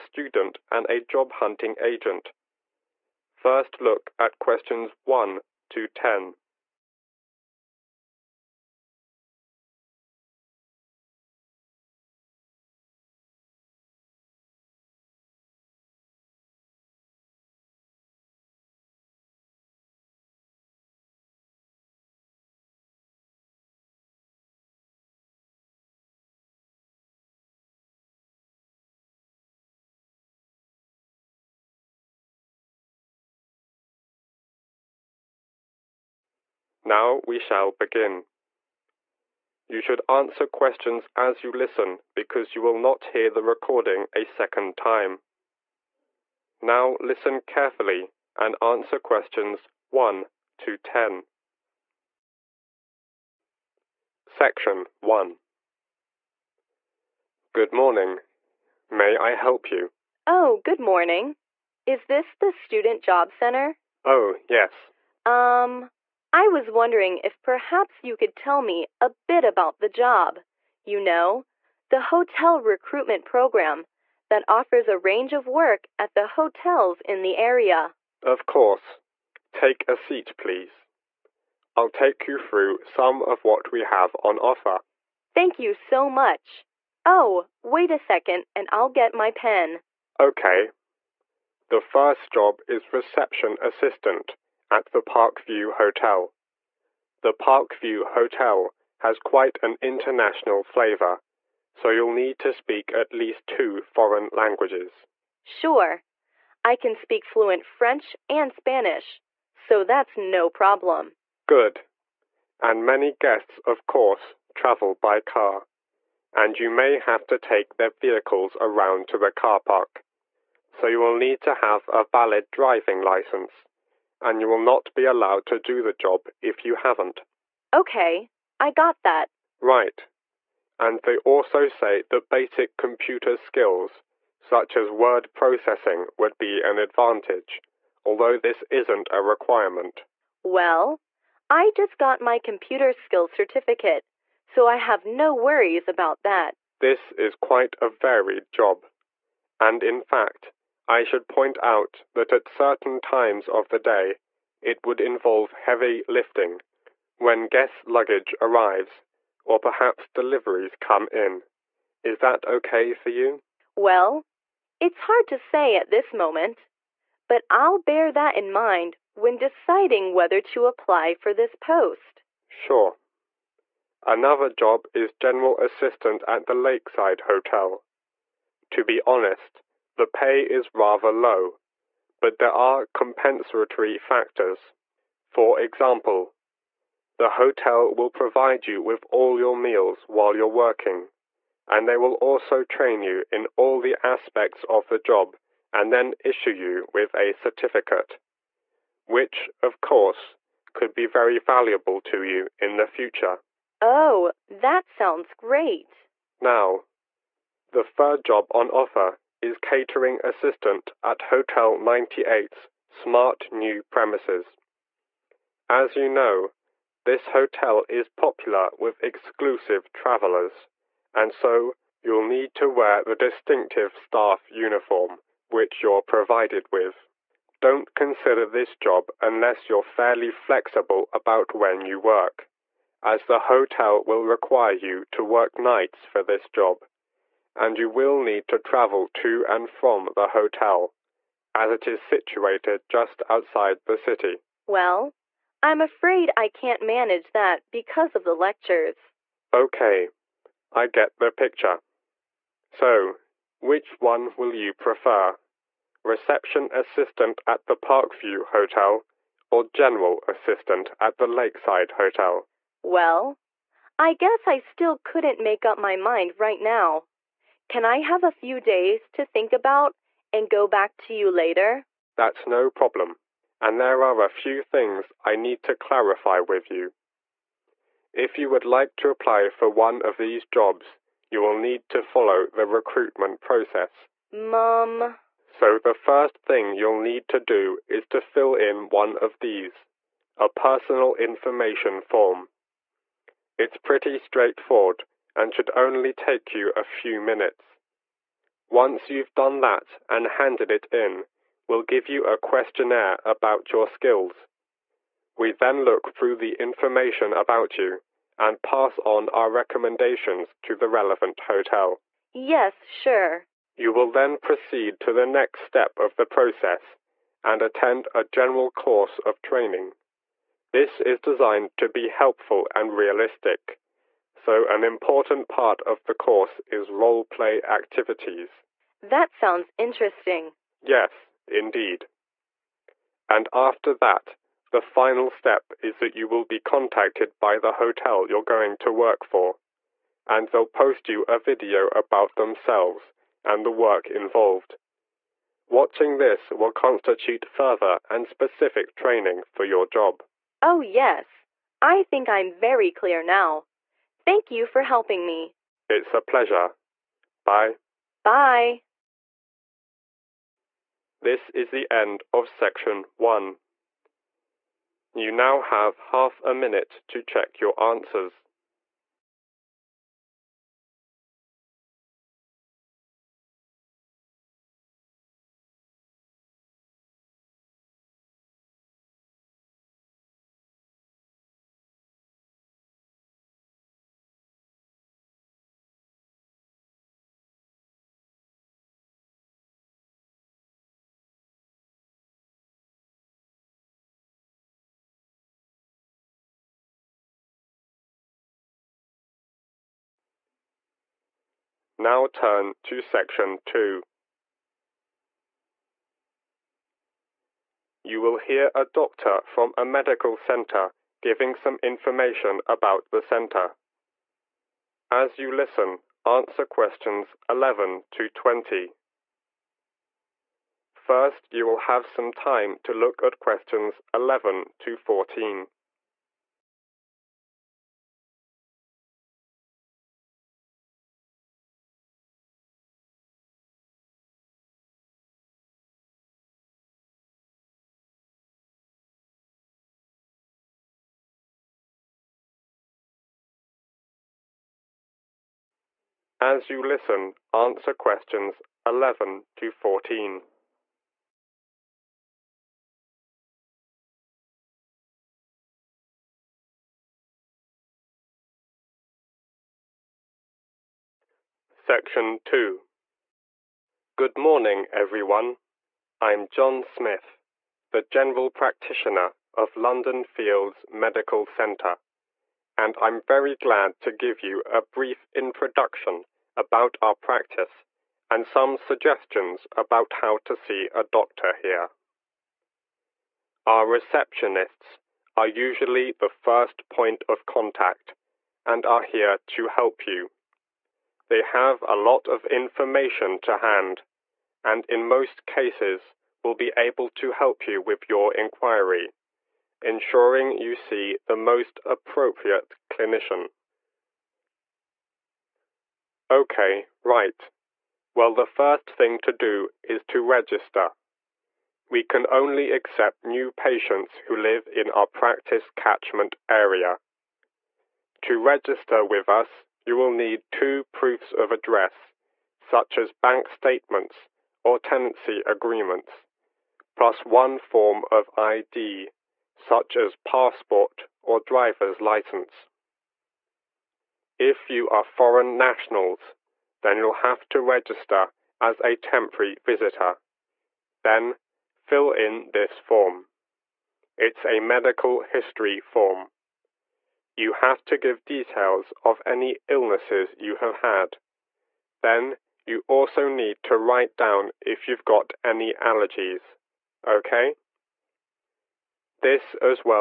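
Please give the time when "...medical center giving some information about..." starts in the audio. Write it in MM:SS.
06:49.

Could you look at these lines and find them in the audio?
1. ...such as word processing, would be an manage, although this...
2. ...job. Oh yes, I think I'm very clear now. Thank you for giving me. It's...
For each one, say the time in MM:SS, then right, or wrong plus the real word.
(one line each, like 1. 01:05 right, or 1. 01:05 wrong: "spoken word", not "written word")
1. 02:14 wrong: "advantage", not "manage"
2. 05:49 wrong: "helping", not "giving".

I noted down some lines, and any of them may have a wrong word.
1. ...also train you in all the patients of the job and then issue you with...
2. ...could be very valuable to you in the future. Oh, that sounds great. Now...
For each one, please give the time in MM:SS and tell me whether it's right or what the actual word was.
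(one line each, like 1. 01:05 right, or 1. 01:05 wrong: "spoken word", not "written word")
1. 03:12 wrong: "aspects", not "patients"
2. 03:20 right.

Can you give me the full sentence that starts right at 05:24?
So an important part of the course is role play activities.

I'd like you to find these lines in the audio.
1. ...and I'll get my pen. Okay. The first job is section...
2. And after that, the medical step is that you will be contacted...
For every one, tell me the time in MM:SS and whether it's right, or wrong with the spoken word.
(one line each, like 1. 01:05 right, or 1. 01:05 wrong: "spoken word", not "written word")
1. 01:28 wrong: "reception", not "section"
2. 05:33 wrong: "final", not "medical".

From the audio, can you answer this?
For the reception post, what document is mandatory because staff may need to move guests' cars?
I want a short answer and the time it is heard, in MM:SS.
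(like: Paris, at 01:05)
valid driving license, at 02:02.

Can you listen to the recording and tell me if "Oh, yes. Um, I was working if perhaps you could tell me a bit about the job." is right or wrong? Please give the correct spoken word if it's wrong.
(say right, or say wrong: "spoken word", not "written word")
wrong: "wondering", not "working".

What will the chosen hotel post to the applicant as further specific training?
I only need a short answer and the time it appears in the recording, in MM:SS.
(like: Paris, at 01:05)
a video, at 05:41.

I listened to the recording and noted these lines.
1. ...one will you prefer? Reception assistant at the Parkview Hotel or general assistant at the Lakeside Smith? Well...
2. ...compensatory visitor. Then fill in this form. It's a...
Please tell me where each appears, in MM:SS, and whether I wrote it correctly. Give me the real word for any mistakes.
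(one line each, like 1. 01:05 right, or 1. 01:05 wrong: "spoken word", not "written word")
1. 04:13 wrong: "Hotel", not "Smith"
2. 08:58 wrong: "temporary", not "compensatory".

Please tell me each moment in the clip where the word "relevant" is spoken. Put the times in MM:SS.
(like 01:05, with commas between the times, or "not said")
05:10.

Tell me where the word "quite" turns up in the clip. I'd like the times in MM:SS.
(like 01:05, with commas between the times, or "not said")
01:39, 02:27.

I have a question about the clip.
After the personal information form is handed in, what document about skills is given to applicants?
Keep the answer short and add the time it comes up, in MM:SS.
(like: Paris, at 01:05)
a questionnaire, at 05:02.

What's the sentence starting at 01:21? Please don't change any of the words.
I'll take you through some of what we have on offer.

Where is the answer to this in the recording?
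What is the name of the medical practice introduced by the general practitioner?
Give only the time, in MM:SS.
07:49.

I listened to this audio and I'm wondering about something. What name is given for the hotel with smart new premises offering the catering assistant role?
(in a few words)
Hotel 98.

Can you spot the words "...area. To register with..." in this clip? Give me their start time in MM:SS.
08:36.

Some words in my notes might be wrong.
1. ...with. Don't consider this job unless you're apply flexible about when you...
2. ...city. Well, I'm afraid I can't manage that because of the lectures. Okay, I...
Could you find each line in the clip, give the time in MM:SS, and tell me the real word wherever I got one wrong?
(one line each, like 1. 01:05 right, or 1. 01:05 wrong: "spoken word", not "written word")
1. 03:46 wrong: "fairly", not "apply"
2. 04:03 right.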